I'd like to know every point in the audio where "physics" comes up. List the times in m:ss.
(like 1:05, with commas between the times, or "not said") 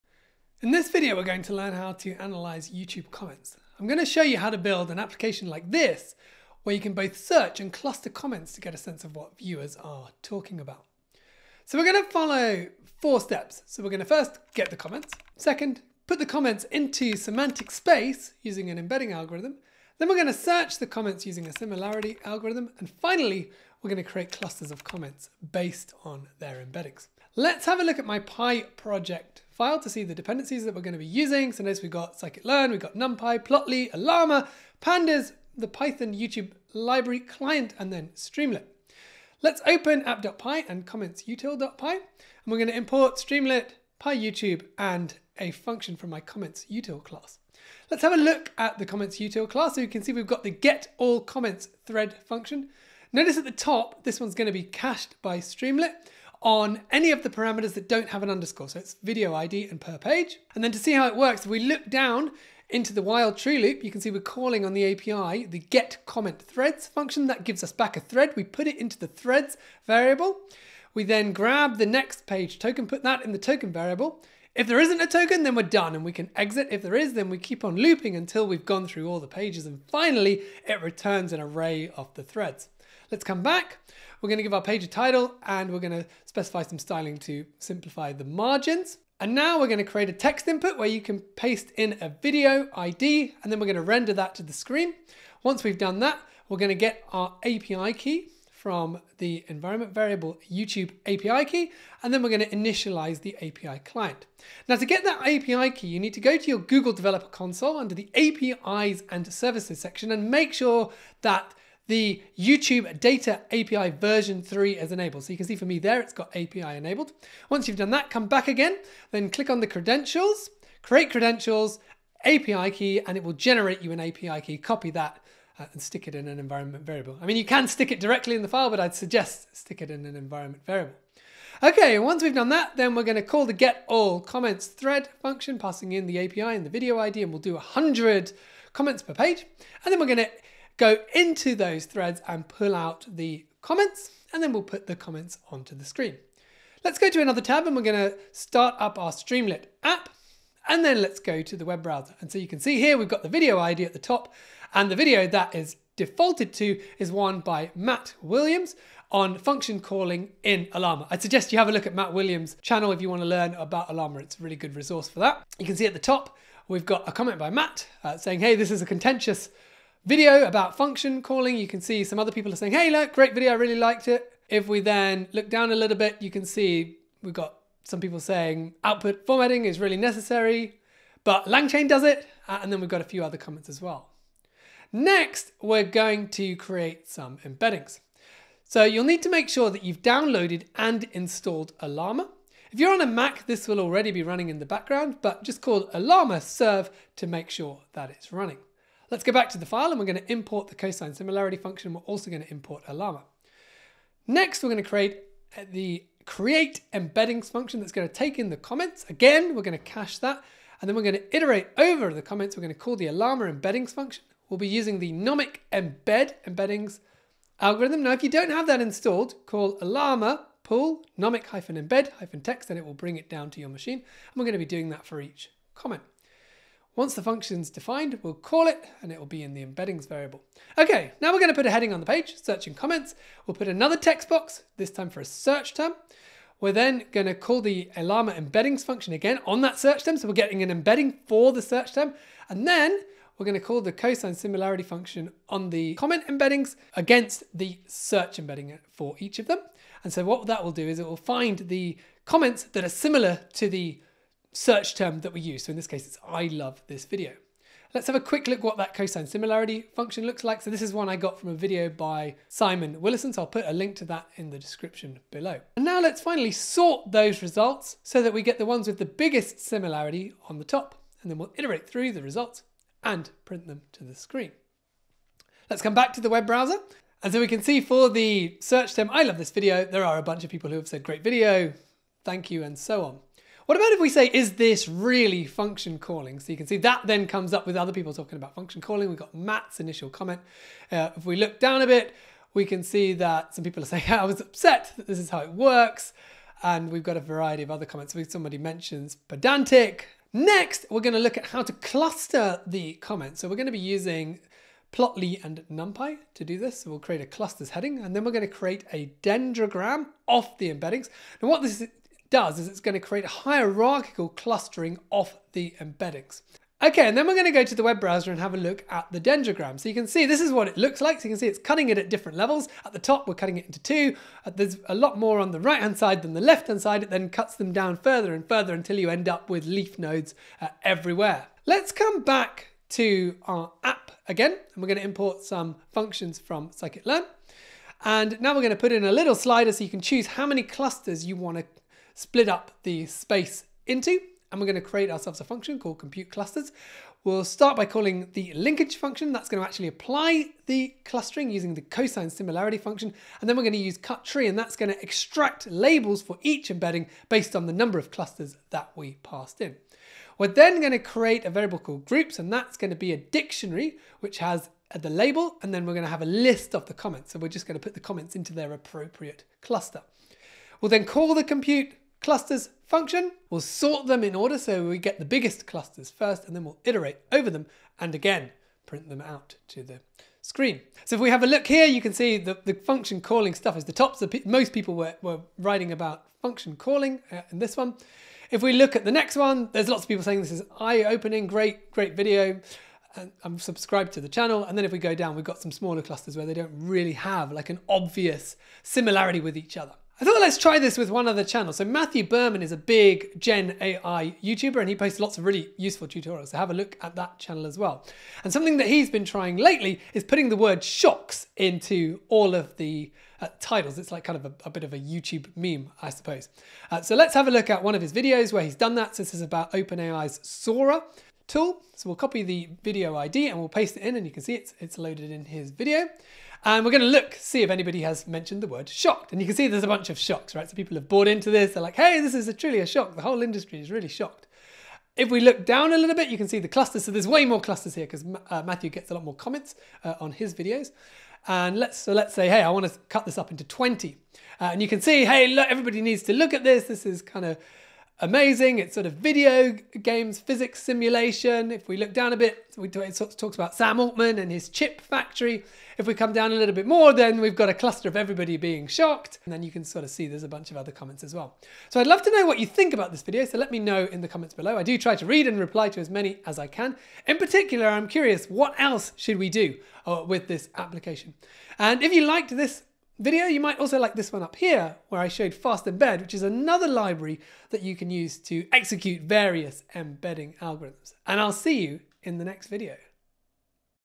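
7:30.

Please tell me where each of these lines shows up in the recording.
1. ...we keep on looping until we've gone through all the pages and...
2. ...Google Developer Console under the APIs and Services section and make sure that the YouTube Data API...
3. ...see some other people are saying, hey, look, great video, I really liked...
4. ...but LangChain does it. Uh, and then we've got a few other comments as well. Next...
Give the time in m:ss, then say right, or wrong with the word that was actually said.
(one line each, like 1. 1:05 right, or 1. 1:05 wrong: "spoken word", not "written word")
1. 1:17 right
2. 1:46 right
3. 2:51 right
4. 3:01 right.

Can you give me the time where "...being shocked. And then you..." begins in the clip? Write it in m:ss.
7:38.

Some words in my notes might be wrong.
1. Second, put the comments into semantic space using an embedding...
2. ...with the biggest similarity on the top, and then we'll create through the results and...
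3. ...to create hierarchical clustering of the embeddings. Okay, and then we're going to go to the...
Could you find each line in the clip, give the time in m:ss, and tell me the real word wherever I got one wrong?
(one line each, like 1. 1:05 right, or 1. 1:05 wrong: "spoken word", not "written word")
1. 0:15 right
2. 4:28 wrong: "iterate", not "create"
3. 5:12 right.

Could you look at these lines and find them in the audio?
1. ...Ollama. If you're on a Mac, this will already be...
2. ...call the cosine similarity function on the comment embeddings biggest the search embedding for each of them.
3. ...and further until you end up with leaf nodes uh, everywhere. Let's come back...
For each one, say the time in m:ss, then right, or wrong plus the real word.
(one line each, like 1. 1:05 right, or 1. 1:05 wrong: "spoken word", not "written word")
1. 3:11 right
2. 4:03 wrong: "against", not "biggest"
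3. 5:28 right.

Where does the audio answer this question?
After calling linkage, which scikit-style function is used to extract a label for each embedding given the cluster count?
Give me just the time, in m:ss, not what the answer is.
5:53.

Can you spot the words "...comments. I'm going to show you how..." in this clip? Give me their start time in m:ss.
0:03.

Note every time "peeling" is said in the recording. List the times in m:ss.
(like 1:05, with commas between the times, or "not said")
not said.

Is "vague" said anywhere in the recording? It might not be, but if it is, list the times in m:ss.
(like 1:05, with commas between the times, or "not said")
not said.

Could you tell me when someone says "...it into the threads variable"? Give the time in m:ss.
1:08.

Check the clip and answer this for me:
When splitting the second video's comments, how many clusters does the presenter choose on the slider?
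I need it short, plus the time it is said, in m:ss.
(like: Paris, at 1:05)
20, at 7:23.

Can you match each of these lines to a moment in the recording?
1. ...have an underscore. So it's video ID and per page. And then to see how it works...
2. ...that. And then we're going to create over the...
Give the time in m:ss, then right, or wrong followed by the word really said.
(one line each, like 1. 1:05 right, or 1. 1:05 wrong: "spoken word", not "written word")
1. 0:58 right
2. 3:30 wrong: "iterate", not "create".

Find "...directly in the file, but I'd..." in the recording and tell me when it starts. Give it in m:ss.
2:07.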